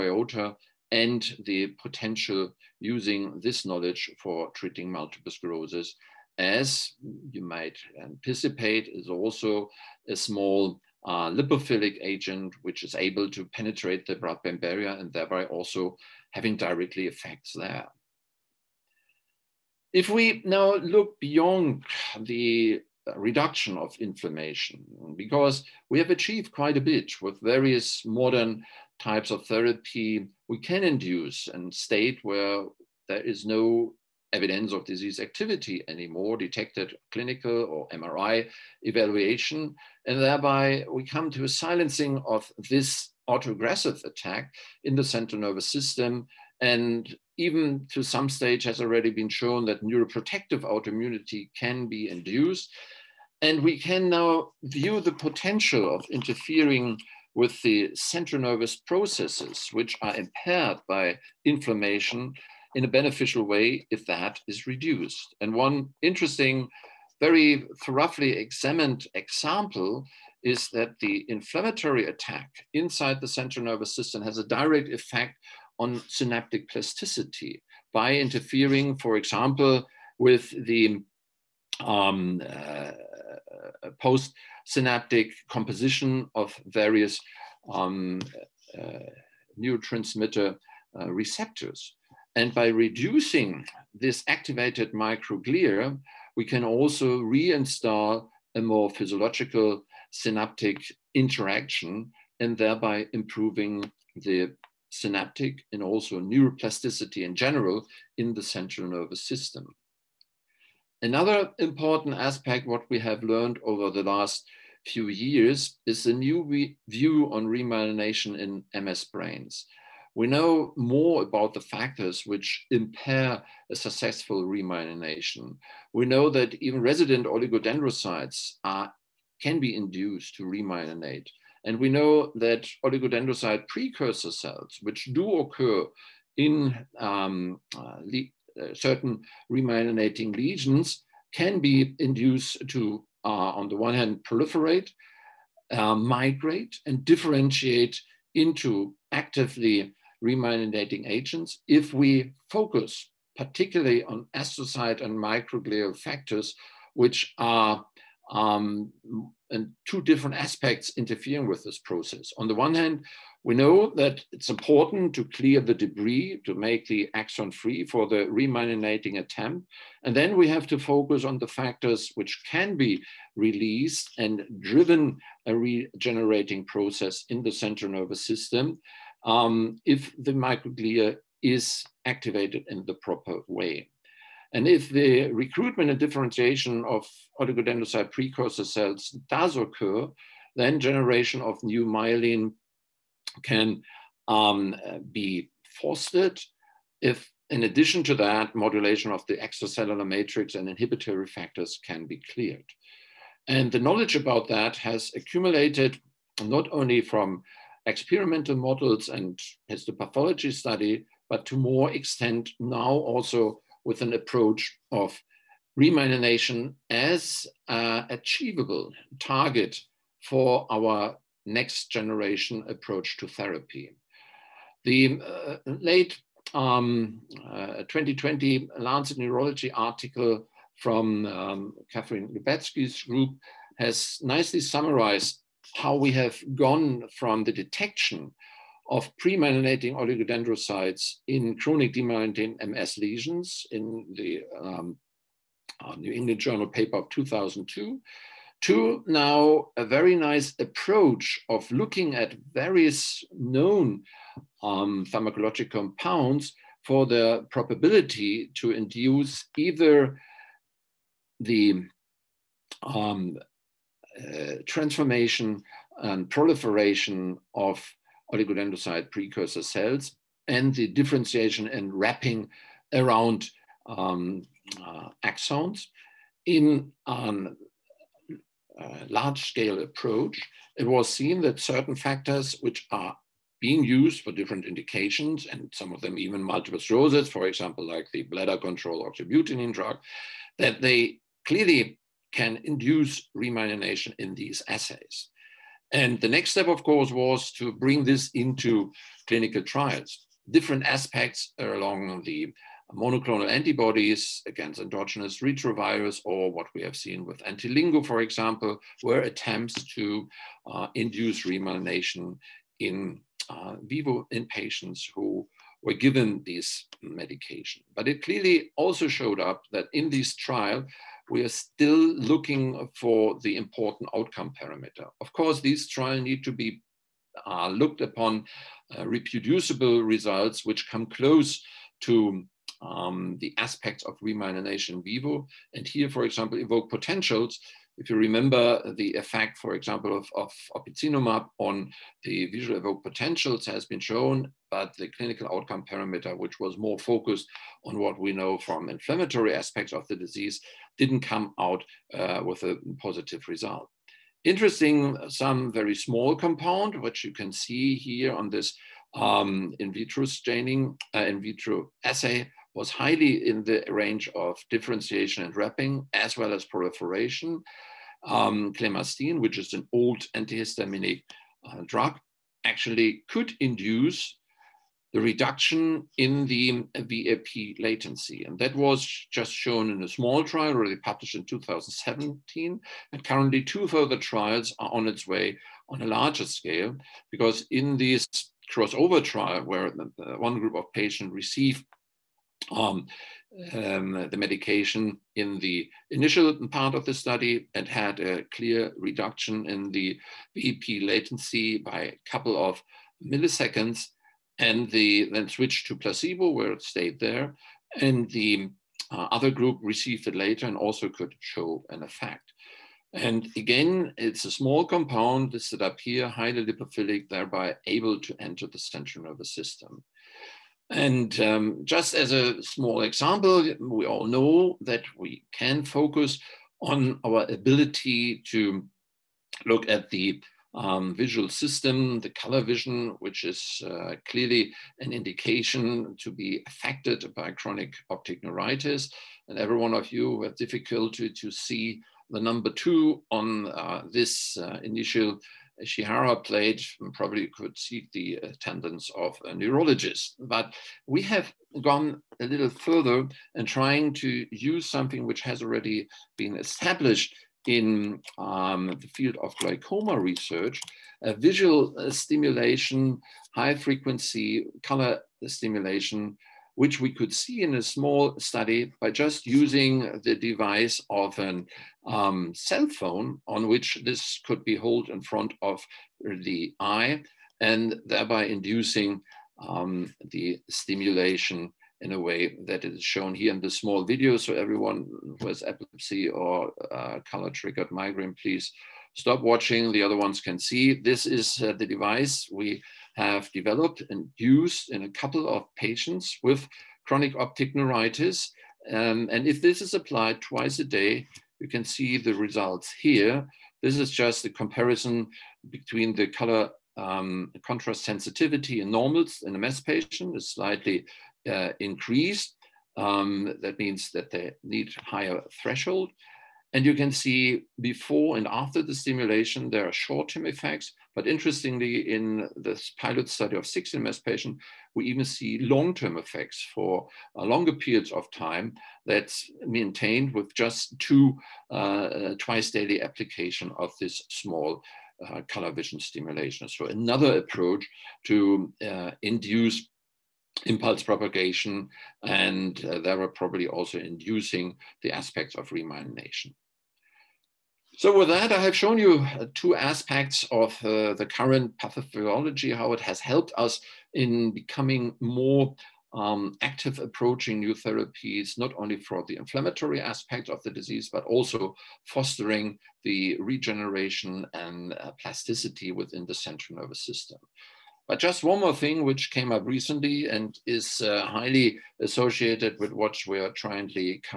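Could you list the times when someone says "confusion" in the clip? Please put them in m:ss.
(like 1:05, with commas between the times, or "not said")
not said.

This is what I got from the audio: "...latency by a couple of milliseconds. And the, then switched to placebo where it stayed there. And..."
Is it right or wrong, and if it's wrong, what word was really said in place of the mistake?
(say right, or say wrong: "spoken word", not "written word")
right.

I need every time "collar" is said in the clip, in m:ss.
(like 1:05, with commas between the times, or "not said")
not said.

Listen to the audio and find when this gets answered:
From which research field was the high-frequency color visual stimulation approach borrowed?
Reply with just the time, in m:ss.
7:39.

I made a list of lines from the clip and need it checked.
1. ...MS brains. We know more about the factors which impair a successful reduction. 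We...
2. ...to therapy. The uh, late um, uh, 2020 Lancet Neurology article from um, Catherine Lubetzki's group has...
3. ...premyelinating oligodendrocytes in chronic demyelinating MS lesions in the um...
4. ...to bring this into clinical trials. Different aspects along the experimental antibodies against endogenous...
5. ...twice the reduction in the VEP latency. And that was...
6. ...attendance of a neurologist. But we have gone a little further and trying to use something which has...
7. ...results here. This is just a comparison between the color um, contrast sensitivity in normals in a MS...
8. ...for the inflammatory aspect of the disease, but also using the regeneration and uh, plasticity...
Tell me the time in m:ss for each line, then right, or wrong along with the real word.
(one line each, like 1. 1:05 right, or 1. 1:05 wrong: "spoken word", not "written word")
1. 1:58 wrong: "remyelination", not "reduction"
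2. 3:43 right
3. 3:59 right
4. 4:57 wrong: "monoclonal", not "experimental"
5. 6:13 wrong: "induce", not "twice"
6. 7:28 right
7. 8:22 right
8. 9:18 wrong: "fostering", not "using".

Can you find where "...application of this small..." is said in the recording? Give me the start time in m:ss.
8:53.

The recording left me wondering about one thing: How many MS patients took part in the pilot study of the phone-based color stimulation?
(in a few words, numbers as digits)
16.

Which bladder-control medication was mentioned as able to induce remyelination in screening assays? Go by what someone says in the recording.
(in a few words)
oxybutynin.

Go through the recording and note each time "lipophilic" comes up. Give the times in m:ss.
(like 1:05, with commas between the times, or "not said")
0:11, 6:56.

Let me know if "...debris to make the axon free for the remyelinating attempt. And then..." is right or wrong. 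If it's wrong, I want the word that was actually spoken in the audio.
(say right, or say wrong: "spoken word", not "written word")
right.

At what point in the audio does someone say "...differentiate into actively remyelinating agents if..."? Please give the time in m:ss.
2:27.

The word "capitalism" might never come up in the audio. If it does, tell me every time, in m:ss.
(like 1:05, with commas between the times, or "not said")
not said.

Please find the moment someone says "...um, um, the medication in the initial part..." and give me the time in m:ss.
6:32.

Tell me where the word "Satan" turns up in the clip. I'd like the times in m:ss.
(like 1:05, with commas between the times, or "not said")
not said.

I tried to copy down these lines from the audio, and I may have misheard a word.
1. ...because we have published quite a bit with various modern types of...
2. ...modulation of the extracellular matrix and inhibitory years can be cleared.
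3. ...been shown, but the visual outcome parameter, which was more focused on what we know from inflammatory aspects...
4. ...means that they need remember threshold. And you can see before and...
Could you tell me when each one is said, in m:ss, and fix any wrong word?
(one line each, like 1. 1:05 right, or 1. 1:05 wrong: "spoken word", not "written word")
1. 0:25 wrong: "achieved", not "published"
2. 3:18 wrong: "factors", not "years"
3. 5:43 wrong: "clinical", not "visual"
4. 8:33 wrong: "higher", not "remember".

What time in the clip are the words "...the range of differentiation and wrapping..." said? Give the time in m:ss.
6:03.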